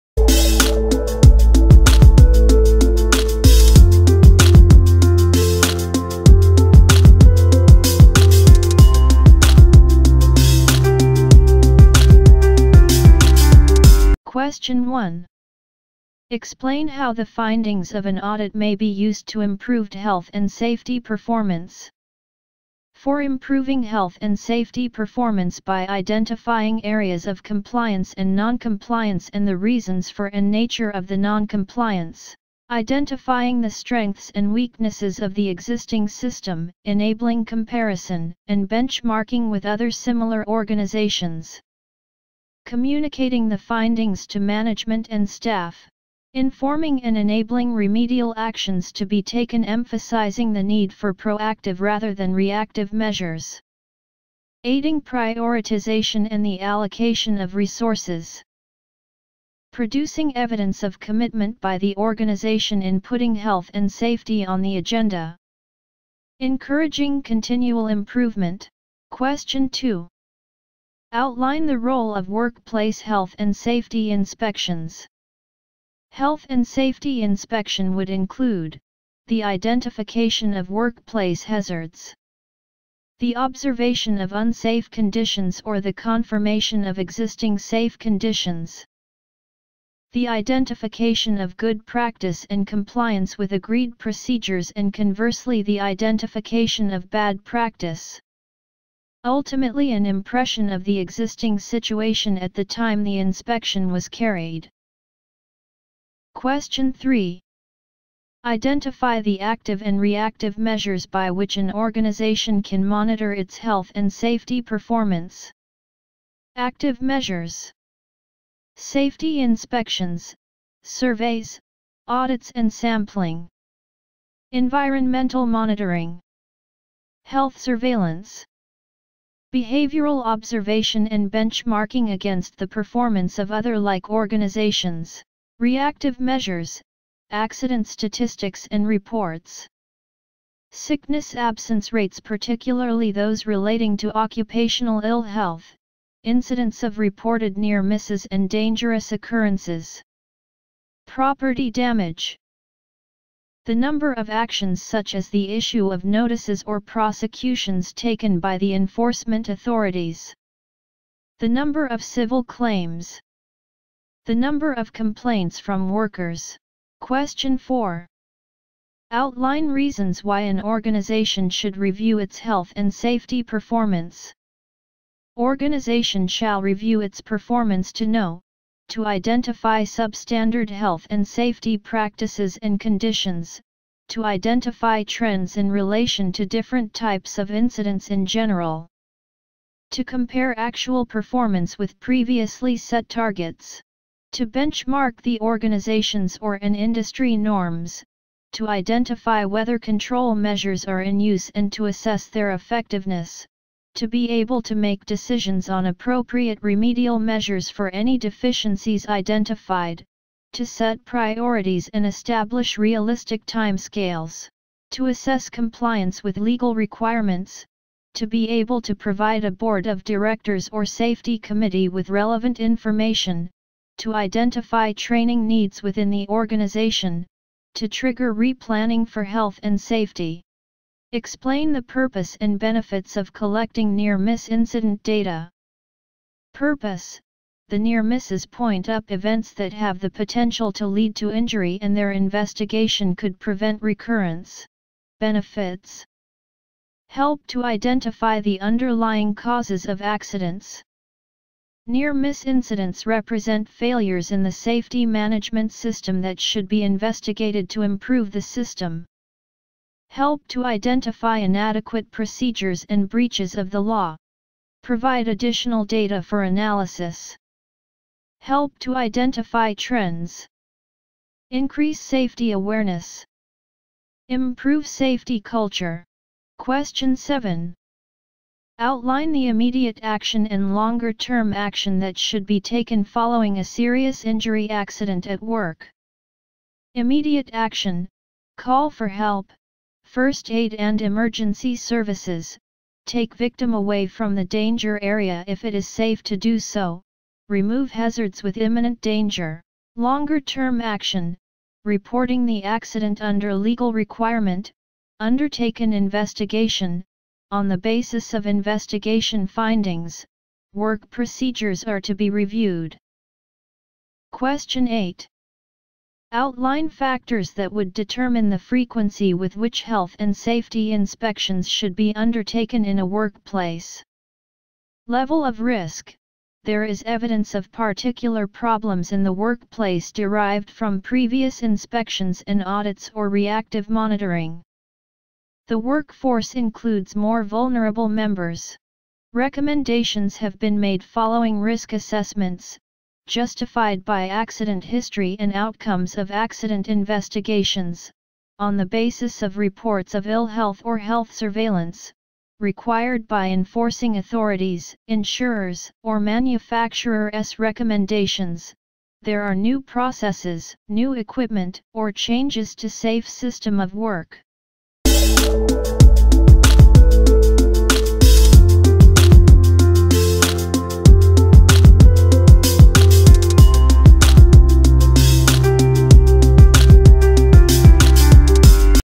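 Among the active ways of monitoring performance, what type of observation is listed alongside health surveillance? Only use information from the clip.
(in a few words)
Behavioral observation.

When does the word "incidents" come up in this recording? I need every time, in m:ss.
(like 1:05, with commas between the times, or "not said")
2:26, 3:07, 3:54, 4:12.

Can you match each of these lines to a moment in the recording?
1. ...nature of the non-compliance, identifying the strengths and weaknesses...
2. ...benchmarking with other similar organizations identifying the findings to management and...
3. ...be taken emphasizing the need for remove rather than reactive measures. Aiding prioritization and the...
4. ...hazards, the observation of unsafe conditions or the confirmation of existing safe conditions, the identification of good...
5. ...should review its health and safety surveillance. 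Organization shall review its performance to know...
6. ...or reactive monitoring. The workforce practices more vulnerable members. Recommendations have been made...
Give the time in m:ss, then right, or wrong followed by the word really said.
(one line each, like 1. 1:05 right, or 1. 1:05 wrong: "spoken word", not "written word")
1. 0:30 right
2. 0:38 wrong: "communicating", not "identifying"
3. 0:49 wrong: "proactive", not "remove"
4. 1:21 right
5. 2:51 wrong: "performance", not "surveillance"
6. 5:33 wrong: "includes", not "practices".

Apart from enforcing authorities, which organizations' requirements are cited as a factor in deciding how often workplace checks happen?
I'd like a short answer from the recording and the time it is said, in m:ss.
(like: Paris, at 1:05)
Insurers, at 5:55.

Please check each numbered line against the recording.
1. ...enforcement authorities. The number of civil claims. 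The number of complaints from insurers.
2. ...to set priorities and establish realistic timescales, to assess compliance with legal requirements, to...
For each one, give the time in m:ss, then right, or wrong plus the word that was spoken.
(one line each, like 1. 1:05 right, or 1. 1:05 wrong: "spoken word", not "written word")
1. 2:38 wrong: "workers", not "insurers"
2. 3:30 right.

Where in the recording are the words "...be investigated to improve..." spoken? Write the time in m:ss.
4:16.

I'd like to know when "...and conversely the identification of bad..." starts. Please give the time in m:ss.
1:34.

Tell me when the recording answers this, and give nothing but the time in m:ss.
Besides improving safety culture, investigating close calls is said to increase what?
4:32.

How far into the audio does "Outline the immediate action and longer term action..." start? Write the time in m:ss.
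4:38.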